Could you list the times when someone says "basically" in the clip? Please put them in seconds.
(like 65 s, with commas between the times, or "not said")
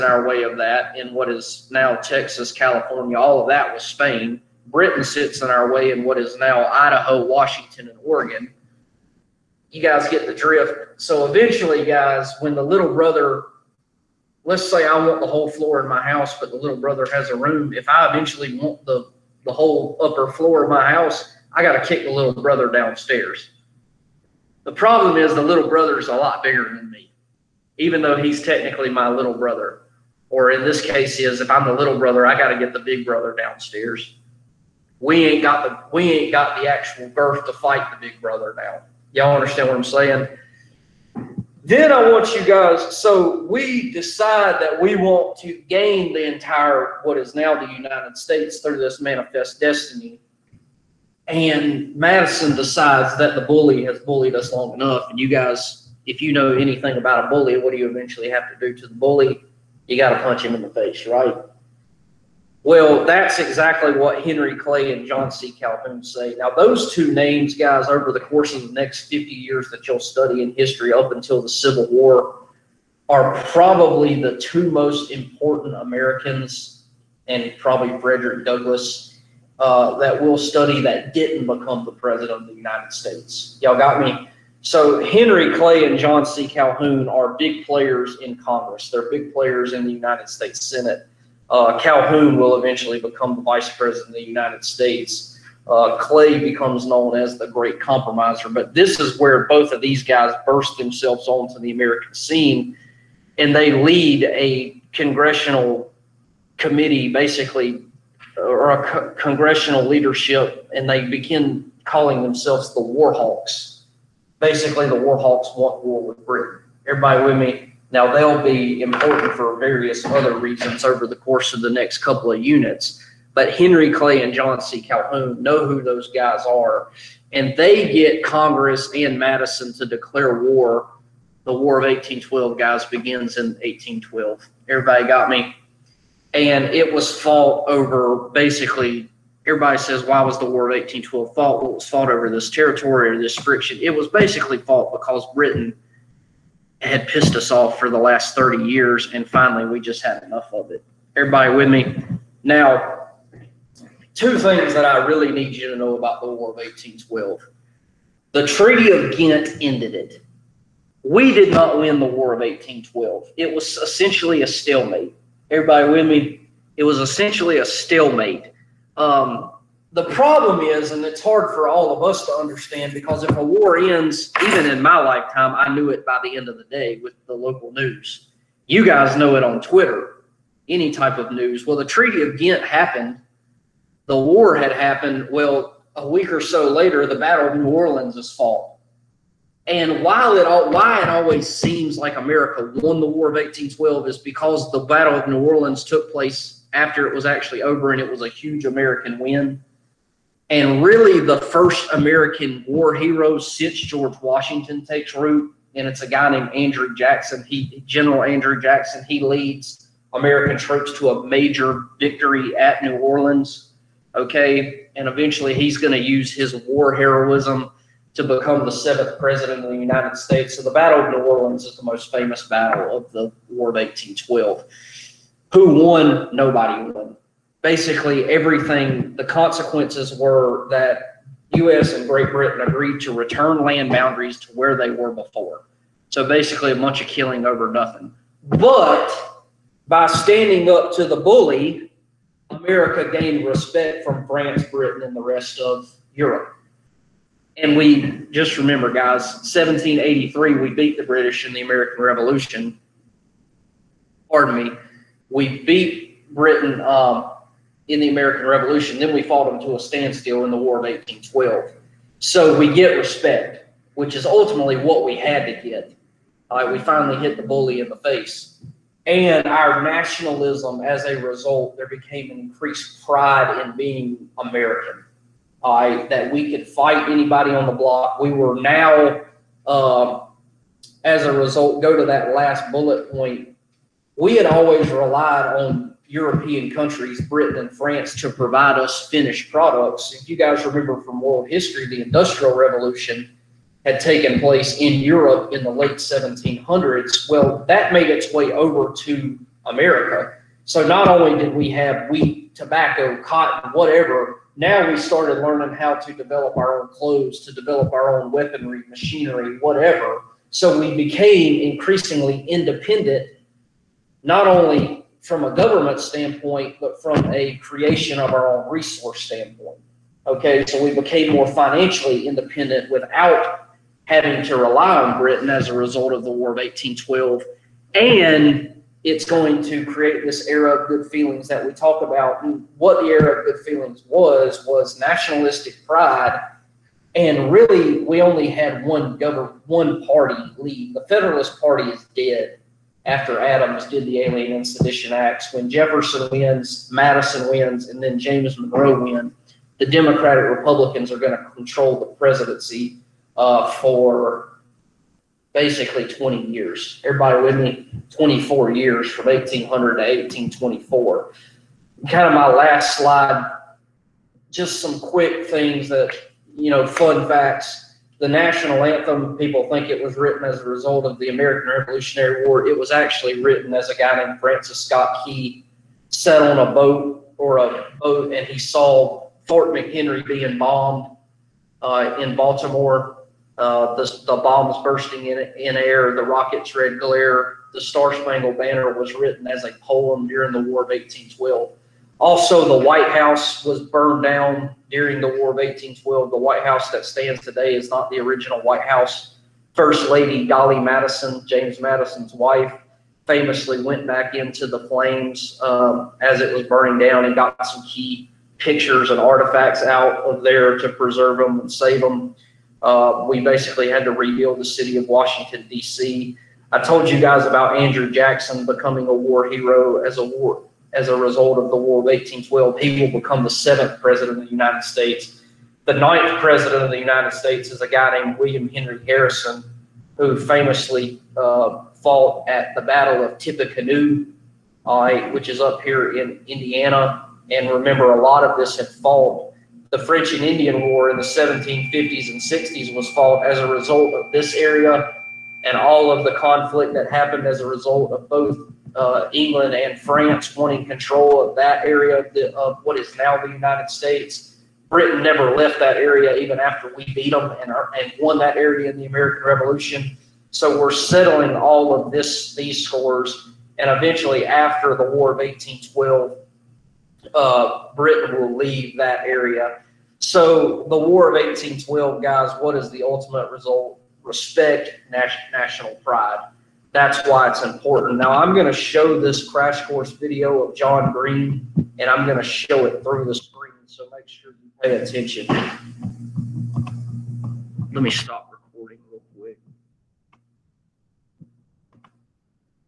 107 s, 114 s, 138 s, 144 s, 227 s, 236 s, 355 s, 413 s.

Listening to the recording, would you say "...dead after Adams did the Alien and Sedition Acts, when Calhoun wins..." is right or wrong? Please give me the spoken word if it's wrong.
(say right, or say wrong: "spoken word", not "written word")
wrong: "Jefferson", not "Calhoun".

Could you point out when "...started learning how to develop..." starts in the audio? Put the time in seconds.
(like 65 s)
304 s.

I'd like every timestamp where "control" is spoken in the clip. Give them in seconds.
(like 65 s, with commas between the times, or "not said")
351 s, 450 s.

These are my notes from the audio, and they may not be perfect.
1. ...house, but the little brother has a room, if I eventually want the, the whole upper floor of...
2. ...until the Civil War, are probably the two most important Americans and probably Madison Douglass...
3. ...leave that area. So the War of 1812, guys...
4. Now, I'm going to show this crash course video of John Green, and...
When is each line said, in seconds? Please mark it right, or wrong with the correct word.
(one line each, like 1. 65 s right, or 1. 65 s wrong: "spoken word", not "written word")
1. 16 s right
2. 71 s wrong: "Frederick", not "Madison"
3. 468 s right
4. 478 s right.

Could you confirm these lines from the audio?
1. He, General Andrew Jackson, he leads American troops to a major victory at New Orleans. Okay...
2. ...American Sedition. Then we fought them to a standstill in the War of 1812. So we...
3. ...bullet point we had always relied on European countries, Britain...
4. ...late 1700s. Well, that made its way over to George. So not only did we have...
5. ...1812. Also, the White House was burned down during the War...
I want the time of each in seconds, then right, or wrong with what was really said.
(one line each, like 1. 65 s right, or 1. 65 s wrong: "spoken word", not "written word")
1. 207 s right
2. 258 s wrong: "Revolution", not "Sedition"
3. 282 s right
4. 295 s wrong: "America", not "George"
5. 390 s right.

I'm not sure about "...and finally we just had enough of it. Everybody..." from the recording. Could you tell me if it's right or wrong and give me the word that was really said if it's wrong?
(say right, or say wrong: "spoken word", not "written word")
right.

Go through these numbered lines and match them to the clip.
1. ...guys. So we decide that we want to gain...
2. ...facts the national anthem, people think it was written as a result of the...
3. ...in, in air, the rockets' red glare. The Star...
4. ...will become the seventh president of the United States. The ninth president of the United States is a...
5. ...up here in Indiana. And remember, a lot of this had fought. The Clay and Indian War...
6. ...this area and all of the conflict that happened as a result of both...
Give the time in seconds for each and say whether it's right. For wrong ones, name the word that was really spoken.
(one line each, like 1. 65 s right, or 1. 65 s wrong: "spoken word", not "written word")
1. 42 s right
2. 367 s right
3. 385 s right
4. 423 s right
5. 435 s wrong: "French", not "Clay"
6. 444 s right.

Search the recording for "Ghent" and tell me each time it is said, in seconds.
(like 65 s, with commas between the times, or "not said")
159 s, 182 s.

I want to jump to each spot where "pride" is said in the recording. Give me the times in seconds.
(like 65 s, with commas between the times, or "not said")
273 s, 335 s, 475 s.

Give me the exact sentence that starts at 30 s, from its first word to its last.
Or in this case, is if I'm the little brother, I got to get the big brother downstairs.